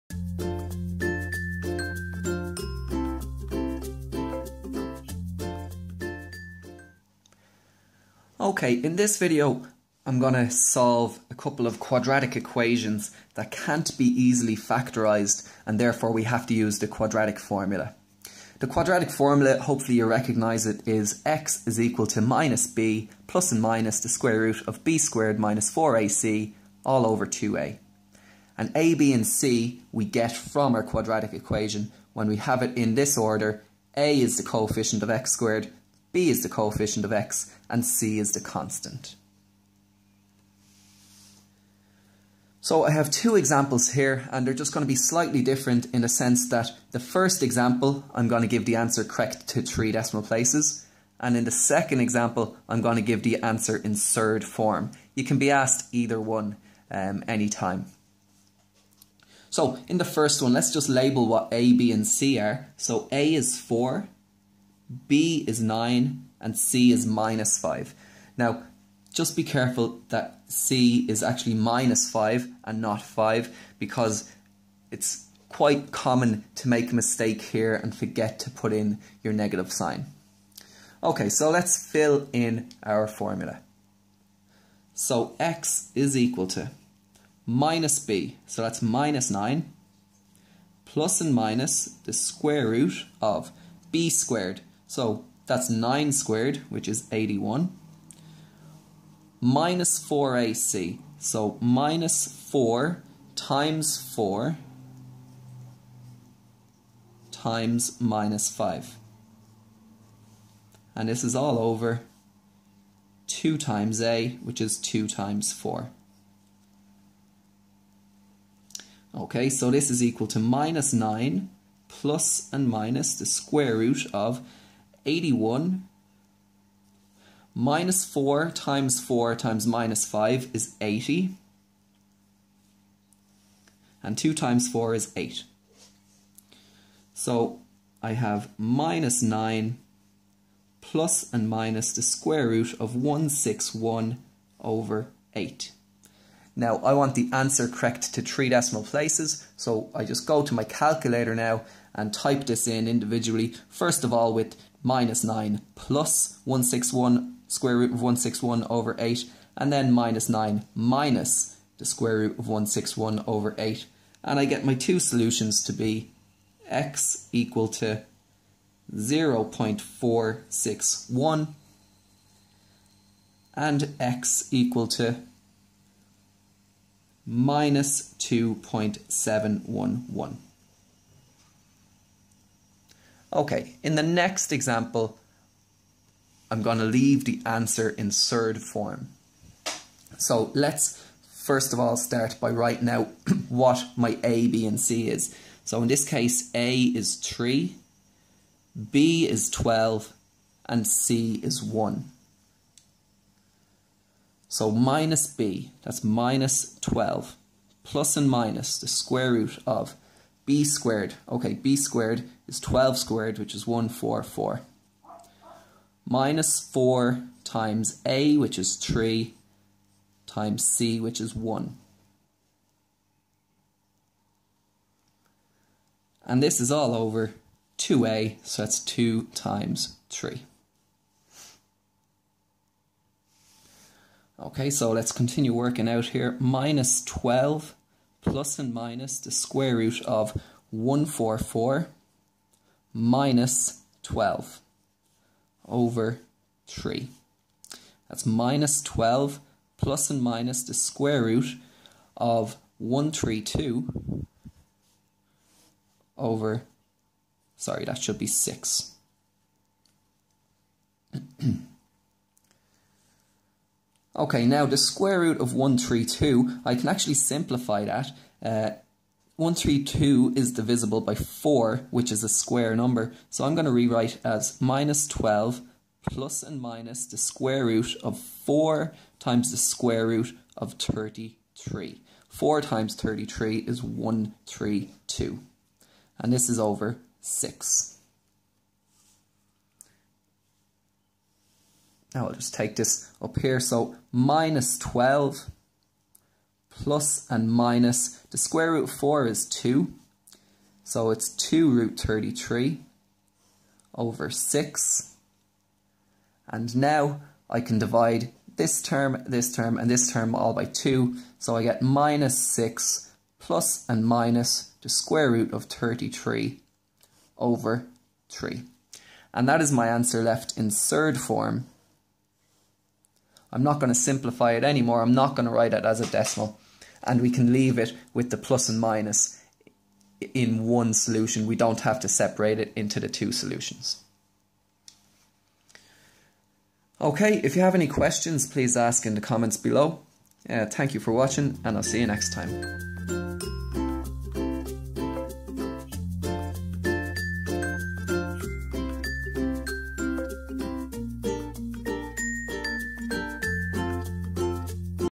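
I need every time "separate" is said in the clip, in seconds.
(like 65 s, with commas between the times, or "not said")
332 s.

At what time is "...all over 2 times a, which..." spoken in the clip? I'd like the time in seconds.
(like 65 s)
111 s.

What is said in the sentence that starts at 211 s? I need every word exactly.
Okay, b squared is 12 squared, which is 144.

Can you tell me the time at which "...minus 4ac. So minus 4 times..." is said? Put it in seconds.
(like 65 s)
99 s.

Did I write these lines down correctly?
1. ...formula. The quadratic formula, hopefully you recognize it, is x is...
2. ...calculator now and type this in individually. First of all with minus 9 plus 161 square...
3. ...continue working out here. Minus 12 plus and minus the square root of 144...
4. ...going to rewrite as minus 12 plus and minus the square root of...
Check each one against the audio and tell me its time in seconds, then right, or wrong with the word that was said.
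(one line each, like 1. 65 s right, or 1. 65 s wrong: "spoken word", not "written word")
1. 17 s right
2. 150 s right
3. 235 s right
4. 273 s right.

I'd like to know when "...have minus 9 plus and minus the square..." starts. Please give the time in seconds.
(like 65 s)
138 s.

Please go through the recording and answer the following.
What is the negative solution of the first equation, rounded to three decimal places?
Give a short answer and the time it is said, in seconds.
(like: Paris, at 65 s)
-2.711, at 177 s.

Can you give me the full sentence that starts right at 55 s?
You can be asked either one um, anytime.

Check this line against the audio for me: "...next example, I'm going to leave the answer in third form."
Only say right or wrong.
right.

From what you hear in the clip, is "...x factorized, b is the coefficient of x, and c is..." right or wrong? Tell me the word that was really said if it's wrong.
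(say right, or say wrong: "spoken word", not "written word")
wrong: "squared", not "factorized".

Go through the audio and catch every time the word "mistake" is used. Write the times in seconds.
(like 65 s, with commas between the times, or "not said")
76 s.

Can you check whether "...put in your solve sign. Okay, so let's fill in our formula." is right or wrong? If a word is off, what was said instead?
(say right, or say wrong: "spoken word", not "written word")
wrong: "negative", not "solve".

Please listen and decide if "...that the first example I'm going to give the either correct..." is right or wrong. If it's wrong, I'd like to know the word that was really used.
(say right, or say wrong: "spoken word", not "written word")
wrong: "answer", not "either".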